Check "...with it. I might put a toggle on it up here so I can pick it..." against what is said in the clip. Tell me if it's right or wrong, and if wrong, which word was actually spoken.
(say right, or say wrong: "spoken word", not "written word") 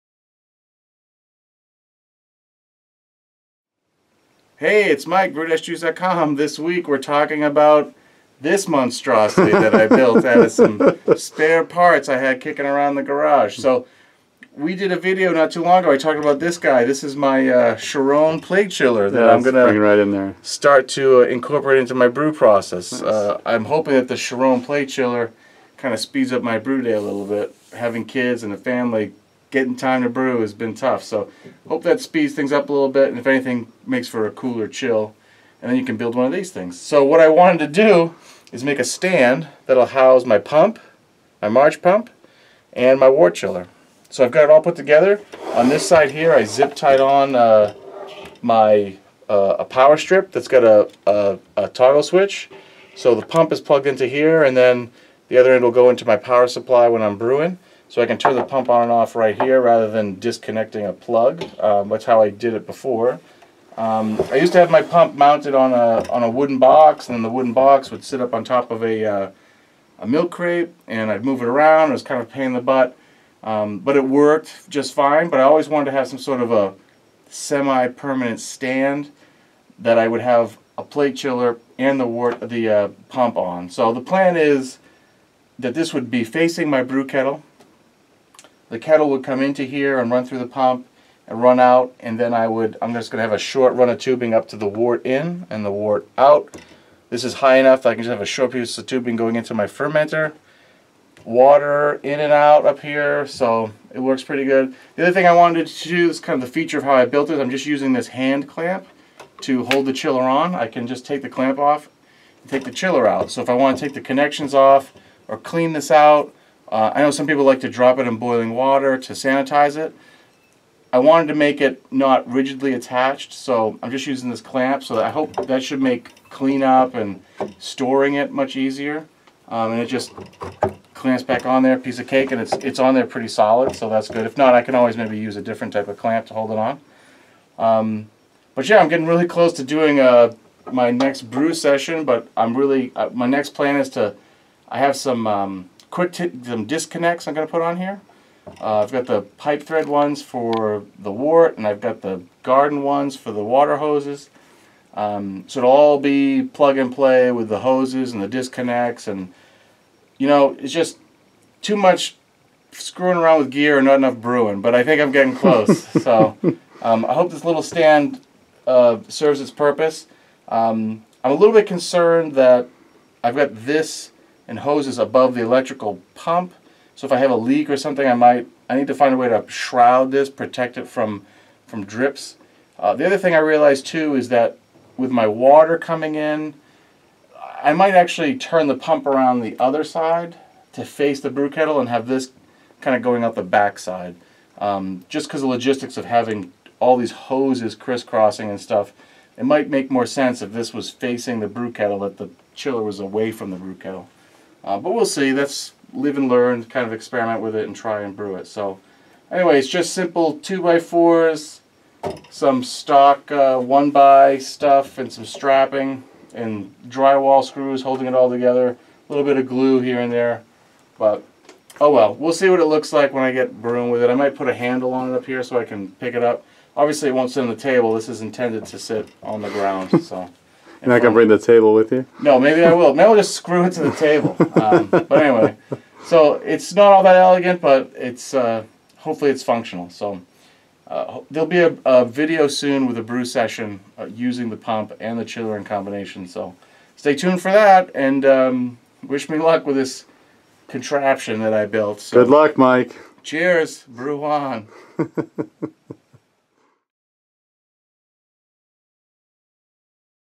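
wrong: "handle", not "toggle".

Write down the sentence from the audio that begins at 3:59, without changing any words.
So uh, there'll be a, a, video soon with a brew session uh, using the pump and the chiller in combination.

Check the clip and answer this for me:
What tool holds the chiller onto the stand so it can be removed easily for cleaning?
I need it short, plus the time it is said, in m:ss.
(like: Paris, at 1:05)
hand clamp, at 1:48.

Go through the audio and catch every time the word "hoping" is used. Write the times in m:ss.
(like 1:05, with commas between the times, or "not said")
0:23.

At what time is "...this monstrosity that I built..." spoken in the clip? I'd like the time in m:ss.
0:08.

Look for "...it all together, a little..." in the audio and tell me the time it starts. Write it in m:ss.
3:38.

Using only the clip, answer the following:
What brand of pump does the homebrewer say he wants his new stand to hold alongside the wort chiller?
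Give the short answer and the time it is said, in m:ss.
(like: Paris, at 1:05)
March, at 0:41.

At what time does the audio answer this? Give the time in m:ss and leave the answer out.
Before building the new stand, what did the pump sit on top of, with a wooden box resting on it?
1:10.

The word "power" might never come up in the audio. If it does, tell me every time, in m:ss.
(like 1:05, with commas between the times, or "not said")
0:49, 0:56.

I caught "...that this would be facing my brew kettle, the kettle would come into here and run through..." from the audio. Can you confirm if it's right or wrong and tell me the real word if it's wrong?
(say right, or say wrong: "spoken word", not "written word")
right.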